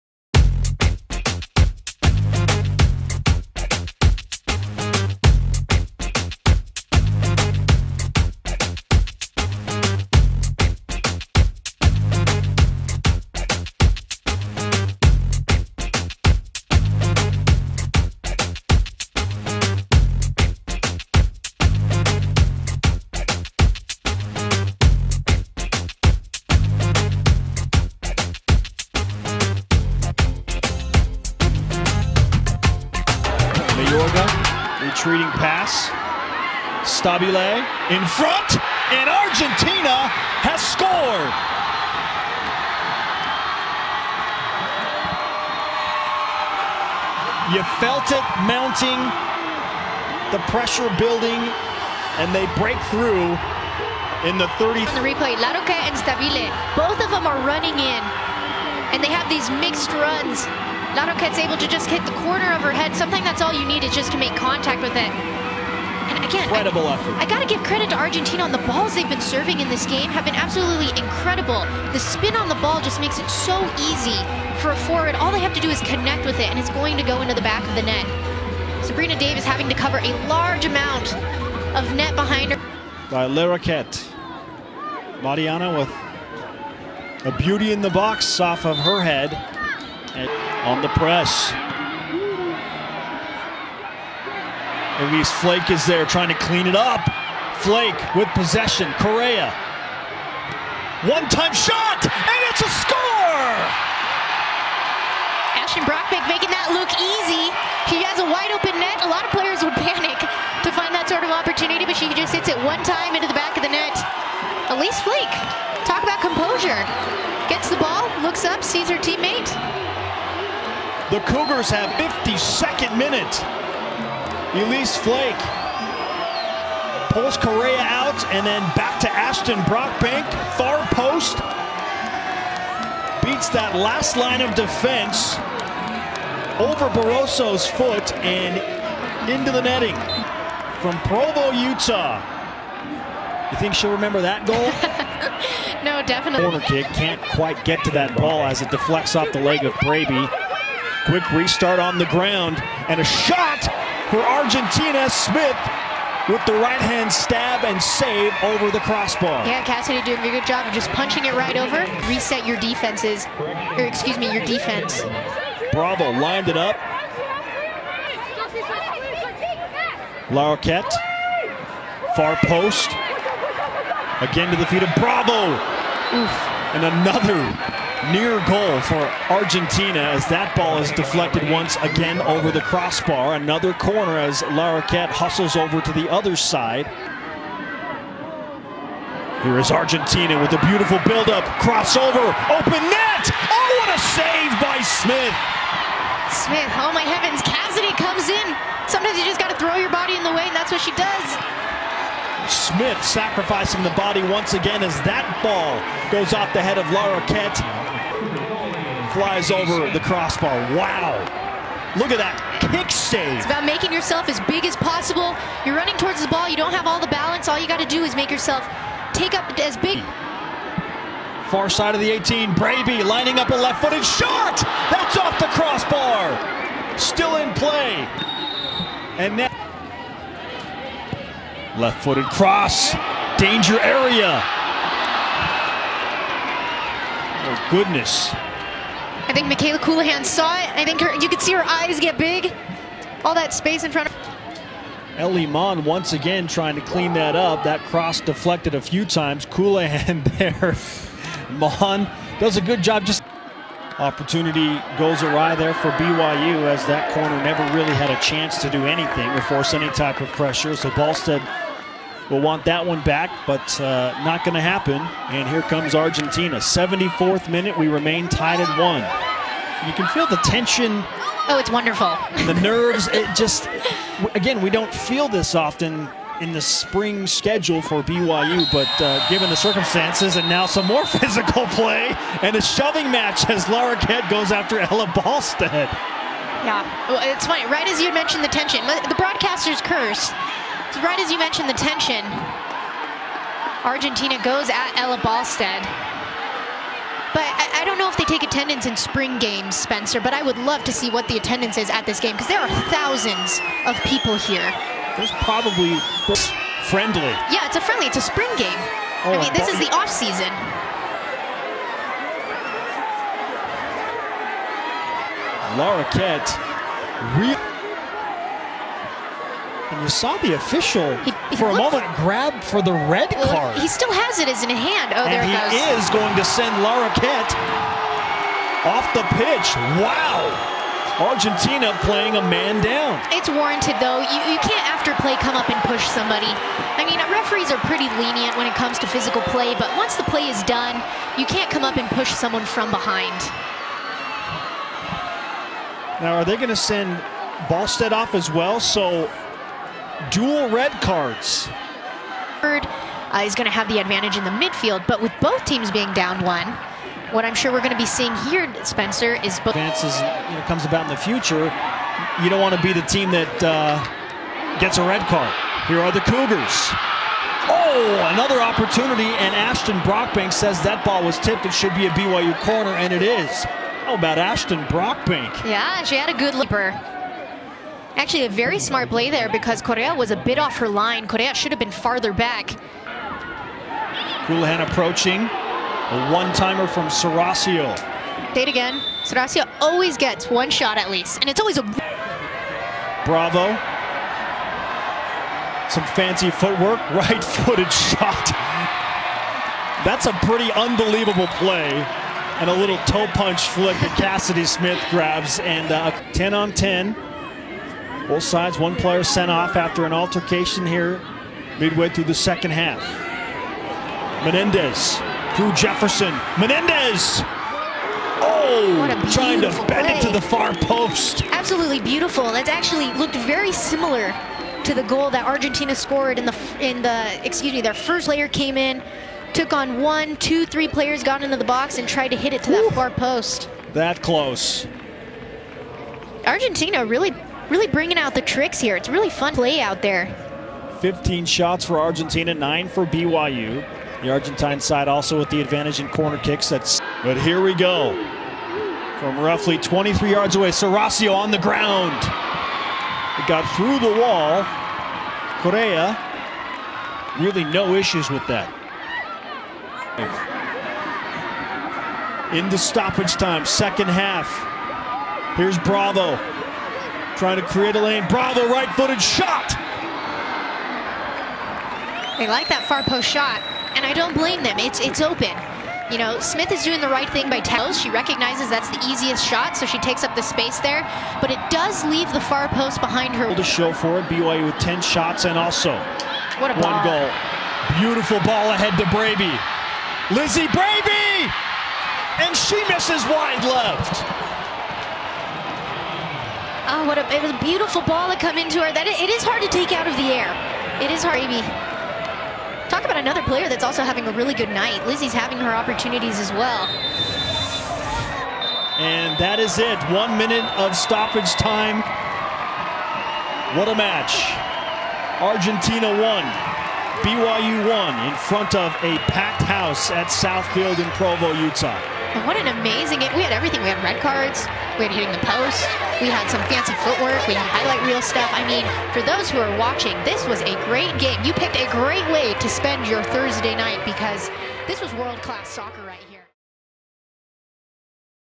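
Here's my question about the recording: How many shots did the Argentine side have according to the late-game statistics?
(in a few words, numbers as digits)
15.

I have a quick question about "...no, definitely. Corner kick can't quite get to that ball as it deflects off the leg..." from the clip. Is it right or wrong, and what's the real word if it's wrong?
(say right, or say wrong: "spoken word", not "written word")
right.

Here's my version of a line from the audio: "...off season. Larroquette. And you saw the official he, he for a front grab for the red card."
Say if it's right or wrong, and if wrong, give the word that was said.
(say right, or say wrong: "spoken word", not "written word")
wrong: "moment", not "front".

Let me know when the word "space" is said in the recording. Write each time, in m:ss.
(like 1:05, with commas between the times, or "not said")
4:03, 8:00.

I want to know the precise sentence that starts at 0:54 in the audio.
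On the replay, Larroquette and Stabile, both of them are running in, and they have these mixed runs.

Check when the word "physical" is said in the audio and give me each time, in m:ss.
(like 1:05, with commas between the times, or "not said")
4:41, 5:39.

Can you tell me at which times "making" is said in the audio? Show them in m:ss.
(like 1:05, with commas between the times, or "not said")
1:46, 3:33.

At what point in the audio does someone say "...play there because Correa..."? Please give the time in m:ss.
6:19.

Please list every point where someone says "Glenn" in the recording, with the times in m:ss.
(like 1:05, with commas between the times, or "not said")
not said.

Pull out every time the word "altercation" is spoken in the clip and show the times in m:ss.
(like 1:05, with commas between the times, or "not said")
6:50.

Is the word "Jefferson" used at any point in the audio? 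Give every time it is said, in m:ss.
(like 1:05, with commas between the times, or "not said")
6:55.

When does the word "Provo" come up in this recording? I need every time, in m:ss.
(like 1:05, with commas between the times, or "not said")
2:21, 8:41.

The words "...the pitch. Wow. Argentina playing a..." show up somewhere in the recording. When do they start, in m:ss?
5:29.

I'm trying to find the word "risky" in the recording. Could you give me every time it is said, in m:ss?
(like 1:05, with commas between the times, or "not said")
not said.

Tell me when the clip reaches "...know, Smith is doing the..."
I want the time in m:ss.
7:56.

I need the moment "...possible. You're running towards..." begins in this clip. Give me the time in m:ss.
3:34.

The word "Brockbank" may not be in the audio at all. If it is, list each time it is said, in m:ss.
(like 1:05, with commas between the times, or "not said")
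1:45, 2:09, 6:09, 6:14.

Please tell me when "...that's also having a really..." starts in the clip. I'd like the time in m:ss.
8:23.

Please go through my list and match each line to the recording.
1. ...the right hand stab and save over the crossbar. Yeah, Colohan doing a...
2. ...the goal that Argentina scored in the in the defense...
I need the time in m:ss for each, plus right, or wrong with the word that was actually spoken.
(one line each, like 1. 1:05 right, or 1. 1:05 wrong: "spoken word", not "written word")
1. 2:36 wrong: "Cassidy", not "Colohan"
2. 7:04 wrong: "excuse", not "defense".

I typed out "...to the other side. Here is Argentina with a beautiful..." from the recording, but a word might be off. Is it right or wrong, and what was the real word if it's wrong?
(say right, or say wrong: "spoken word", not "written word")
right.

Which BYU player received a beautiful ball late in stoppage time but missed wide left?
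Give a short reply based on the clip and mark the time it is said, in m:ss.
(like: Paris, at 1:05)
Lizzie Braby, at 8:10.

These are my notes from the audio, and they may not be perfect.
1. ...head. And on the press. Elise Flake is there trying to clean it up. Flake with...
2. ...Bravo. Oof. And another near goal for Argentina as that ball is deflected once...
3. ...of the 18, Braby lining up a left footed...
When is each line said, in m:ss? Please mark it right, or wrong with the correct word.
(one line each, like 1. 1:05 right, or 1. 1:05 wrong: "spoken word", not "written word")
1. 1:29 right
2. 2:54 right
3. 3:41 right.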